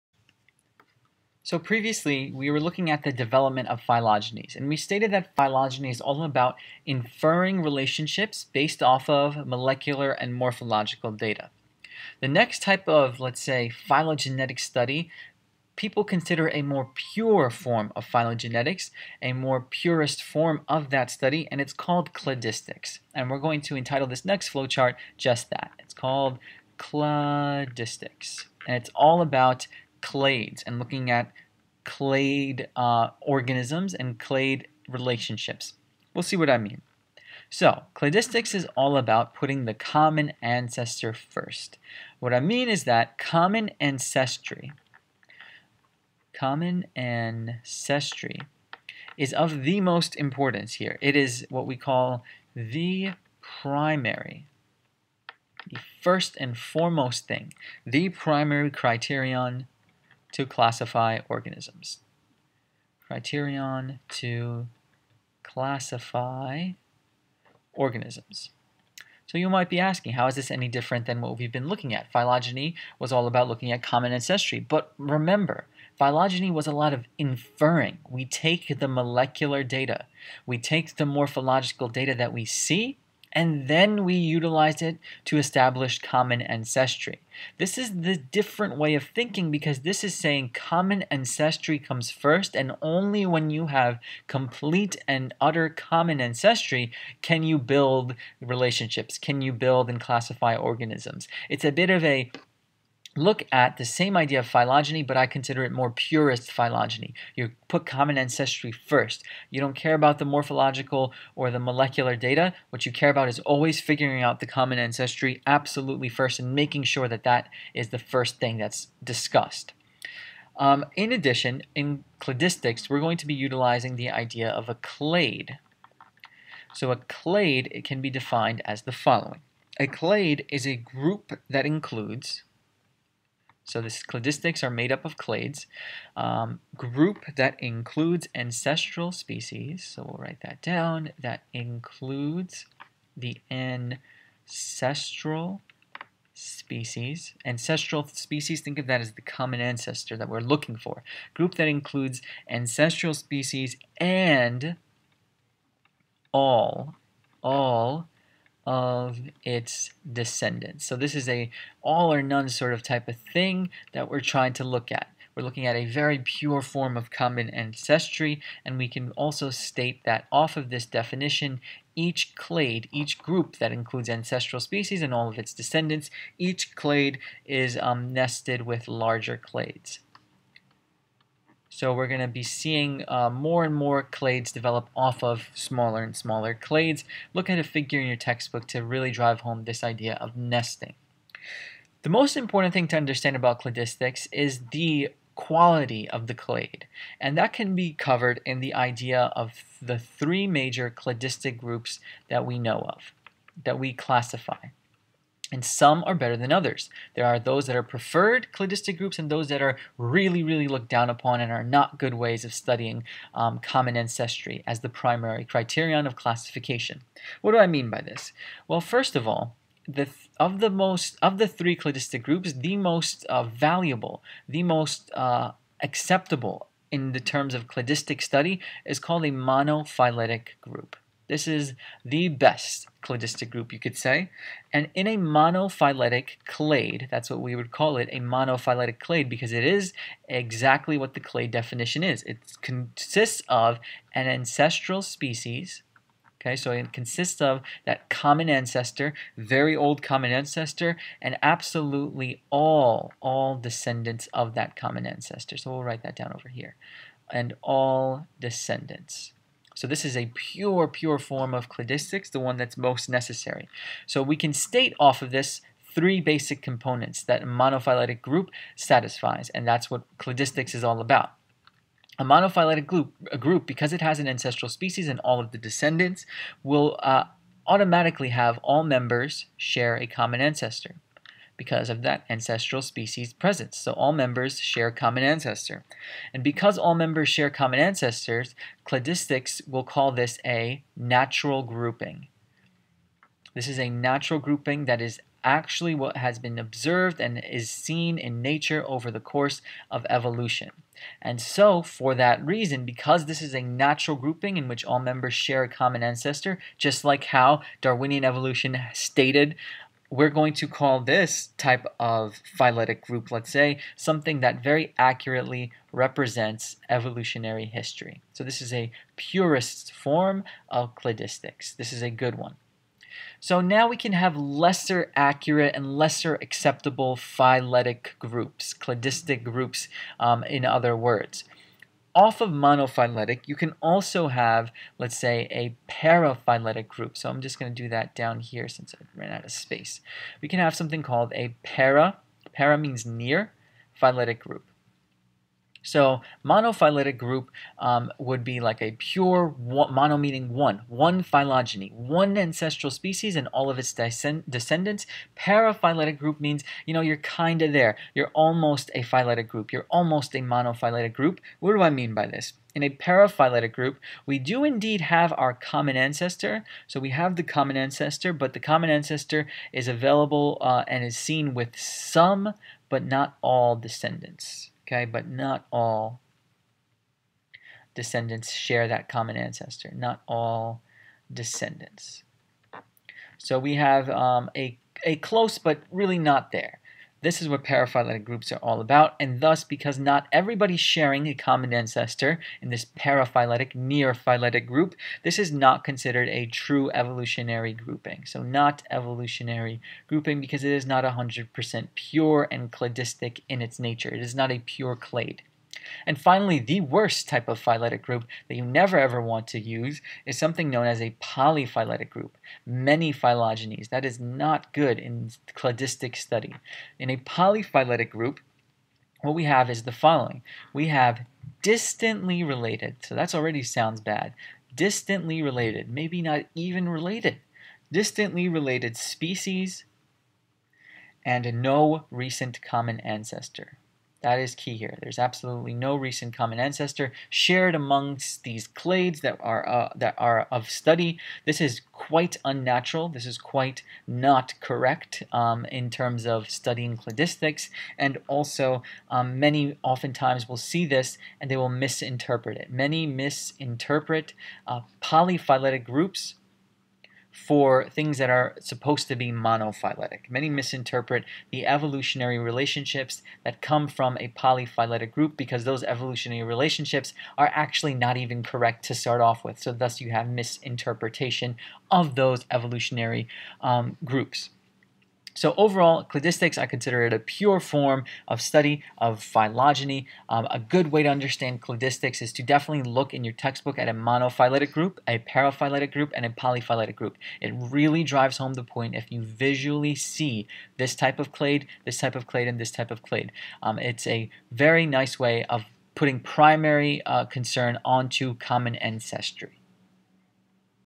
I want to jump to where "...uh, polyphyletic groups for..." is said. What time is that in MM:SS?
07:34.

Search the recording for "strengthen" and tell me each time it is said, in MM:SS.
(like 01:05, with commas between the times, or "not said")
not said.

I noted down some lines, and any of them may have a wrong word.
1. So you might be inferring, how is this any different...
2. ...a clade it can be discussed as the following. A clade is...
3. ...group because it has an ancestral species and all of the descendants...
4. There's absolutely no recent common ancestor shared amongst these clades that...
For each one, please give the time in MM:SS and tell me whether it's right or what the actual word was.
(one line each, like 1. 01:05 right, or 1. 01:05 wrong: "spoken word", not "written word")
1. 01:09 wrong: "asking", not "inferring"
2. 02:06 wrong: "defined", not "discussed"
3. 04:33 right
4. 07:15 right.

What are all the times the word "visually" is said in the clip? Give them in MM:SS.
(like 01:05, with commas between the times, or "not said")
08:09.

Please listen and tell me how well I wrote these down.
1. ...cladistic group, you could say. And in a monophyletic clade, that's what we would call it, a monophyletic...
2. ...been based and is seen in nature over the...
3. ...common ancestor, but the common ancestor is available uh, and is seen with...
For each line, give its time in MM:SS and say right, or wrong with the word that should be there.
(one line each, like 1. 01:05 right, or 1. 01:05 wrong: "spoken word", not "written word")
1. 03:53 right
2. 04:56 wrong: "observed", not "based"
3. 06:07 right.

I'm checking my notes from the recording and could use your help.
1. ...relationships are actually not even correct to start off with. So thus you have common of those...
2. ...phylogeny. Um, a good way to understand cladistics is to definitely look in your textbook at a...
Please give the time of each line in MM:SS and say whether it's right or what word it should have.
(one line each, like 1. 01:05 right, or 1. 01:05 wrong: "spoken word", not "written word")
1. 07:46 wrong: "misinterpretation", not "common"
2. 07:59 right.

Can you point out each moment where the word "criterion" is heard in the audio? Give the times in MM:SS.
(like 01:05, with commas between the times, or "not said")
00:58, 01:03, 03:35.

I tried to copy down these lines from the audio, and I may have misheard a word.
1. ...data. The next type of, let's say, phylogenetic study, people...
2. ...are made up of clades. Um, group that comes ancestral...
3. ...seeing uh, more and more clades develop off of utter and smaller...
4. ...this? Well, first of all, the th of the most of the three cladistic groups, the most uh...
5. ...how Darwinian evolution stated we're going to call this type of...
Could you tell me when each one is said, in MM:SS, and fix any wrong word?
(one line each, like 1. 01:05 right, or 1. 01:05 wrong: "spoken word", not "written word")
1. 00:11 right
2. 02:14 wrong: "includes", not "comes"
3. 03:02 wrong: "smaller", not "utter"
4. 03:38 right
5. 05:07 right.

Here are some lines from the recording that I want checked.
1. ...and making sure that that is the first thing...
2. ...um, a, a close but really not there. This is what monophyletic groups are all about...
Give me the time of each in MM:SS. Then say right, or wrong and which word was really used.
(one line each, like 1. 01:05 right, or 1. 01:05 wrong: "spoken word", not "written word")
1. 01:56 right
2. 06:24 wrong: "paraphyletic", not "monophyletic".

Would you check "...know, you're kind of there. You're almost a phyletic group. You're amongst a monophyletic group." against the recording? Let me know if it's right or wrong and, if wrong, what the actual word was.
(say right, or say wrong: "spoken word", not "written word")
wrong: "almost", not "amongst".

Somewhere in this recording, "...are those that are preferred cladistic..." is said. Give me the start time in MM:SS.
03:27.